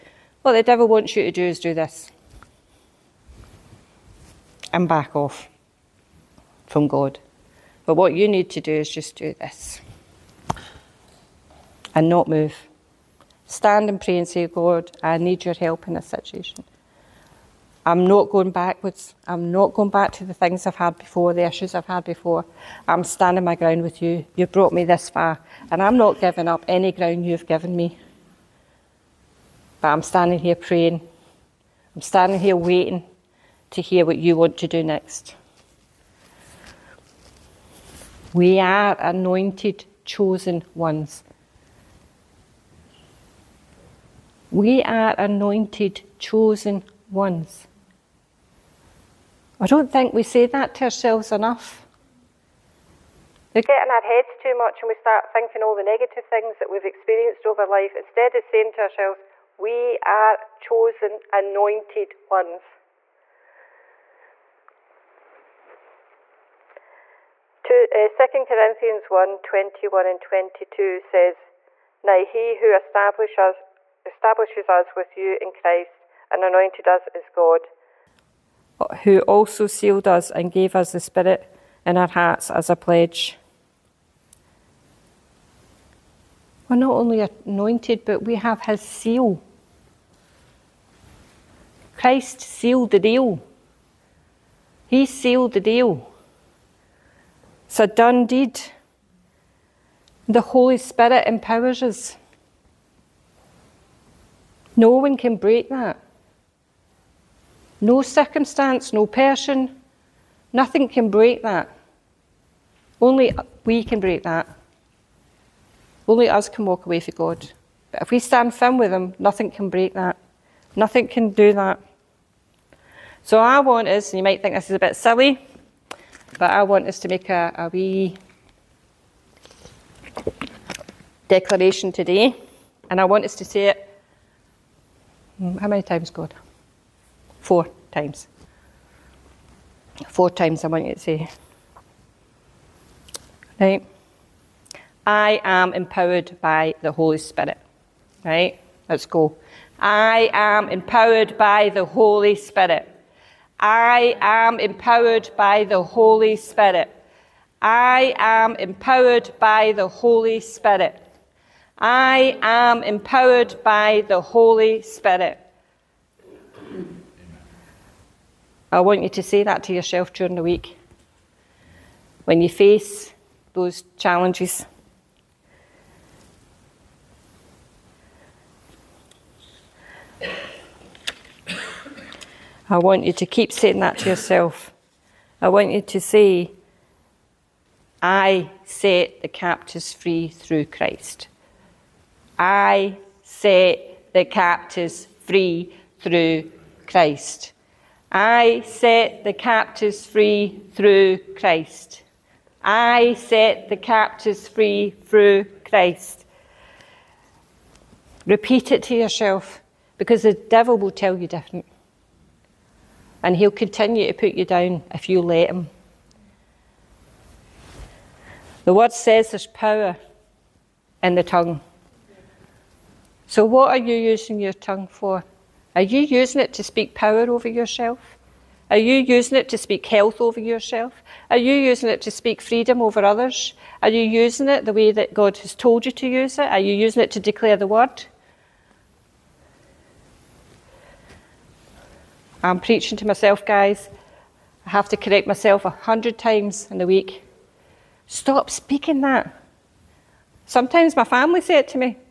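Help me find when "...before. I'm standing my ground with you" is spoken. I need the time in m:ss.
0:22.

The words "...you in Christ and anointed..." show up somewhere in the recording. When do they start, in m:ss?
1:15.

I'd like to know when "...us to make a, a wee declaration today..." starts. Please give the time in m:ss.
2:06.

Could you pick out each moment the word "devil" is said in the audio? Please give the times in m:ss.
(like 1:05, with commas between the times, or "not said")
0:00, 3:30.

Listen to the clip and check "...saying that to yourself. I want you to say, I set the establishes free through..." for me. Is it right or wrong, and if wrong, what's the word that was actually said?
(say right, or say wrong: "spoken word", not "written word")
wrong: "captives", not "establishes".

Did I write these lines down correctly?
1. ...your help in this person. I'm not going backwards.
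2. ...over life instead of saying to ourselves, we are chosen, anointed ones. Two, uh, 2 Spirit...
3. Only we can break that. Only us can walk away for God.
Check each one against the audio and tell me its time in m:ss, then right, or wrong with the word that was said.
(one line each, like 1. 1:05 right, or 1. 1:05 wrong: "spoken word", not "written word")
1. 0:15 wrong: "situation", not "person"
2. 0:57 wrong: "Corinthians", not "Spirit"
3. 1:52 right.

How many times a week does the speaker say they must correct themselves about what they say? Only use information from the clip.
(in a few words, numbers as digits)
100.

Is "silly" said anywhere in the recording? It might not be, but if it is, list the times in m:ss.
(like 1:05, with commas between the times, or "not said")
2:04.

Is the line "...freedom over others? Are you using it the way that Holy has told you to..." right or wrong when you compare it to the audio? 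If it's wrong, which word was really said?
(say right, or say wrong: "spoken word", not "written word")
wrong: "God", not "Holy".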